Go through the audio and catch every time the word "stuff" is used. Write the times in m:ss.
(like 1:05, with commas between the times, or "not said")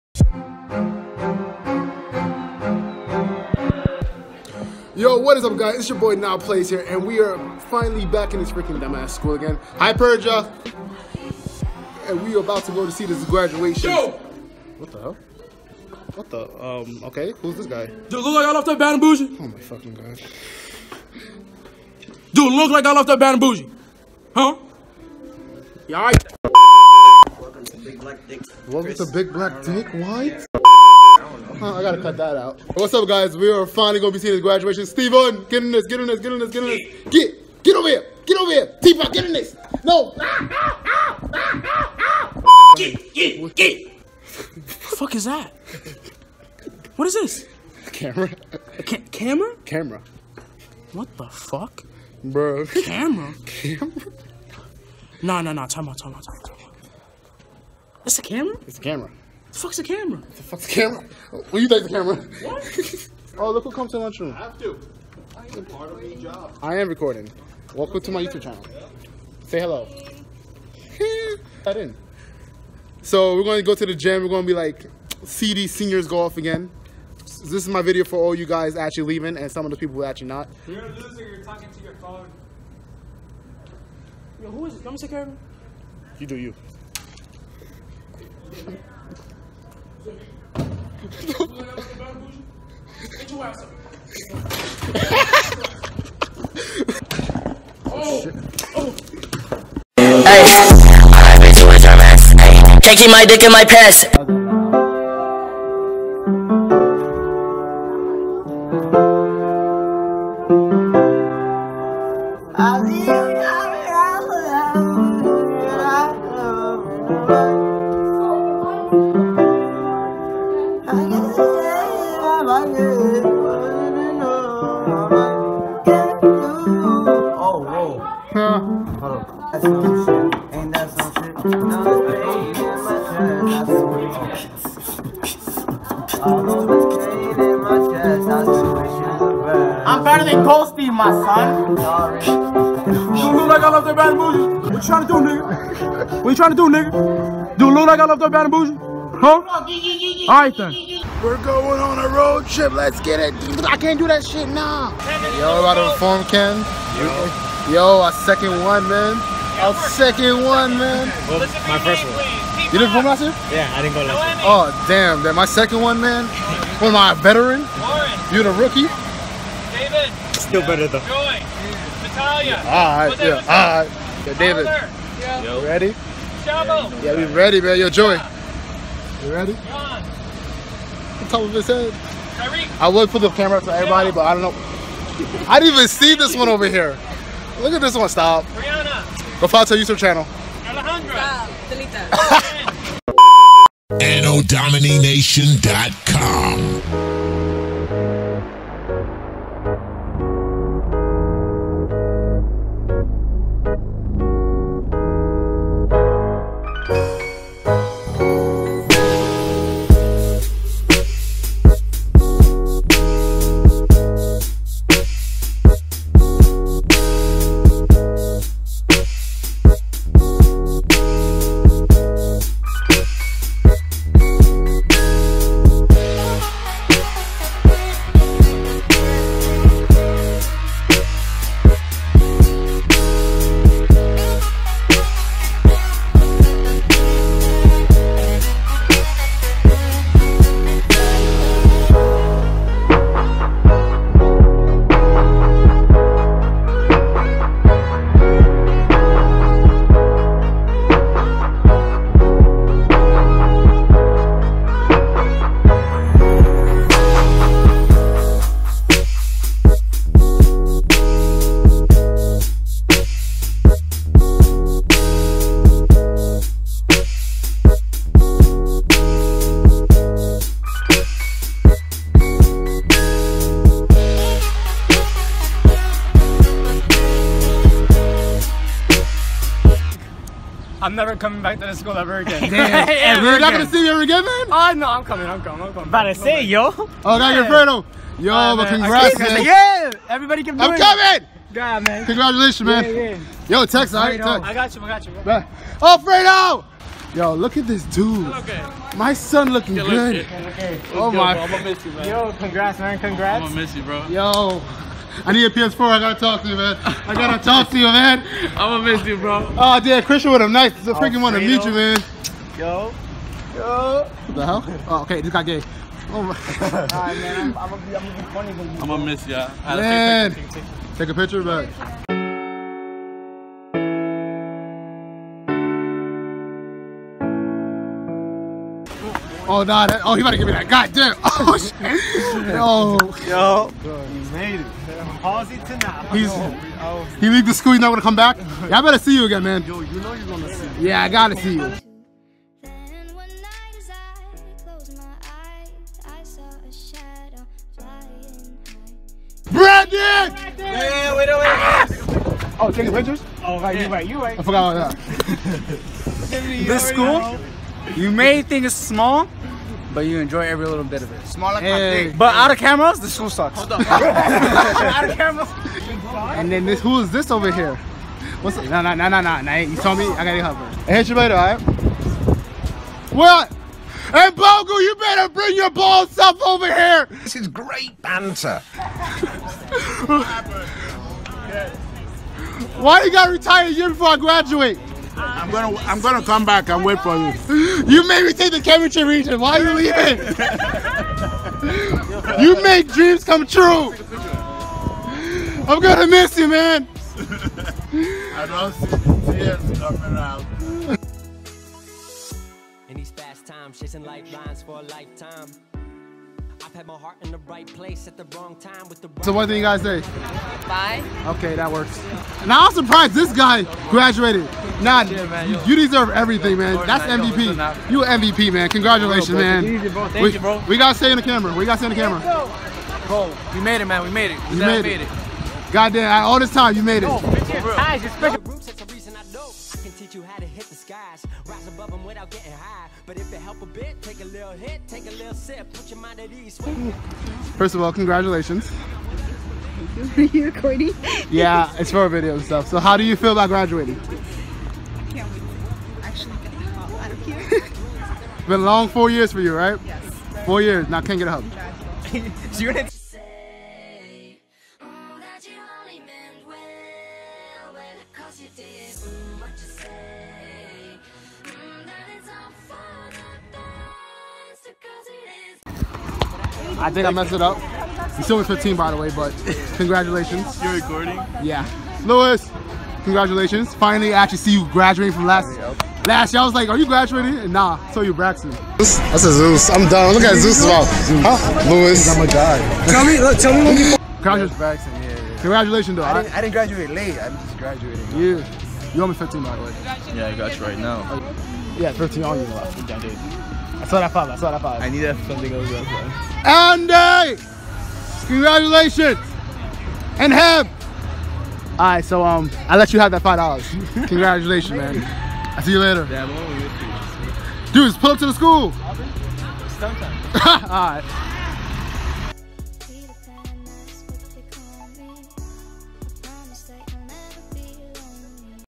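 6:16, 7:22.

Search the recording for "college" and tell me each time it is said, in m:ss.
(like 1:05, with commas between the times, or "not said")
not said.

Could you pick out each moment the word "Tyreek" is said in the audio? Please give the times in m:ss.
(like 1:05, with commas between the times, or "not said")
3:02.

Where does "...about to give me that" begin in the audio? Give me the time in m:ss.
5:30.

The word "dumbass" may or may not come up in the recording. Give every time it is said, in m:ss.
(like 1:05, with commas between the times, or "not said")
0:08.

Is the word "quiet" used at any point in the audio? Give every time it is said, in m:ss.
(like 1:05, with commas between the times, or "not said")
not said.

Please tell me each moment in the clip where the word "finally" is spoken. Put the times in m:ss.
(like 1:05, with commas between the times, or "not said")
0:07, 0:33, 7:53.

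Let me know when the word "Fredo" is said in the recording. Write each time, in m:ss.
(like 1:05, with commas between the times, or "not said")
4:47, 4:56.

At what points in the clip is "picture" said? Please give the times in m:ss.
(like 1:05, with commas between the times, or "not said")
5:21, 5:52.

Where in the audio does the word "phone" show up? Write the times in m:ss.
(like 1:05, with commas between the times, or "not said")
1:21.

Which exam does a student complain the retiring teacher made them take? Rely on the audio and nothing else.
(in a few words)
chemistry region.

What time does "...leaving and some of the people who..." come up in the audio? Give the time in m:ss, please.
1:19.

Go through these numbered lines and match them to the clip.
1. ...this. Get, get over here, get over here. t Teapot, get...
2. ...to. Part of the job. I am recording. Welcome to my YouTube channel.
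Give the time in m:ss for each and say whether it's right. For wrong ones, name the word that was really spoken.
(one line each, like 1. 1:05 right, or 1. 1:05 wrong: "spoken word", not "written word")
1. 0:36 right
2. 1:04 right.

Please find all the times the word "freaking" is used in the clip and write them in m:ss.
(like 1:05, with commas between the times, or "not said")
0:08, 5:10.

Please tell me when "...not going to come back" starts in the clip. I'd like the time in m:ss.
5:37.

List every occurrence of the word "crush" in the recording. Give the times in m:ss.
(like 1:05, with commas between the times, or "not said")
not said.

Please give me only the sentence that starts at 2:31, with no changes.
We're going on a road trip.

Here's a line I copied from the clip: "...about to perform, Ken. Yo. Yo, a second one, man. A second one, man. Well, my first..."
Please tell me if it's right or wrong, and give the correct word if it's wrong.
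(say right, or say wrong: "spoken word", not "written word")
right.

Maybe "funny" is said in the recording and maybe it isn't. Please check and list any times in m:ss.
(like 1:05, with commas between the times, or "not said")
5:18.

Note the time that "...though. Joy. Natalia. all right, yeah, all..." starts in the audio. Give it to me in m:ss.
2:50.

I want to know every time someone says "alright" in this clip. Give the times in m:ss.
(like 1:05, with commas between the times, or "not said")
2:30, 5:16, 6:11, 8:21, 8:30.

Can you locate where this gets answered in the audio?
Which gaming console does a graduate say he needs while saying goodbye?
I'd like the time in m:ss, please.
5:05.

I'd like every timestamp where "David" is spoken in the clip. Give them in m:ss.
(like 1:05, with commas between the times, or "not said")
2:49, 2:54.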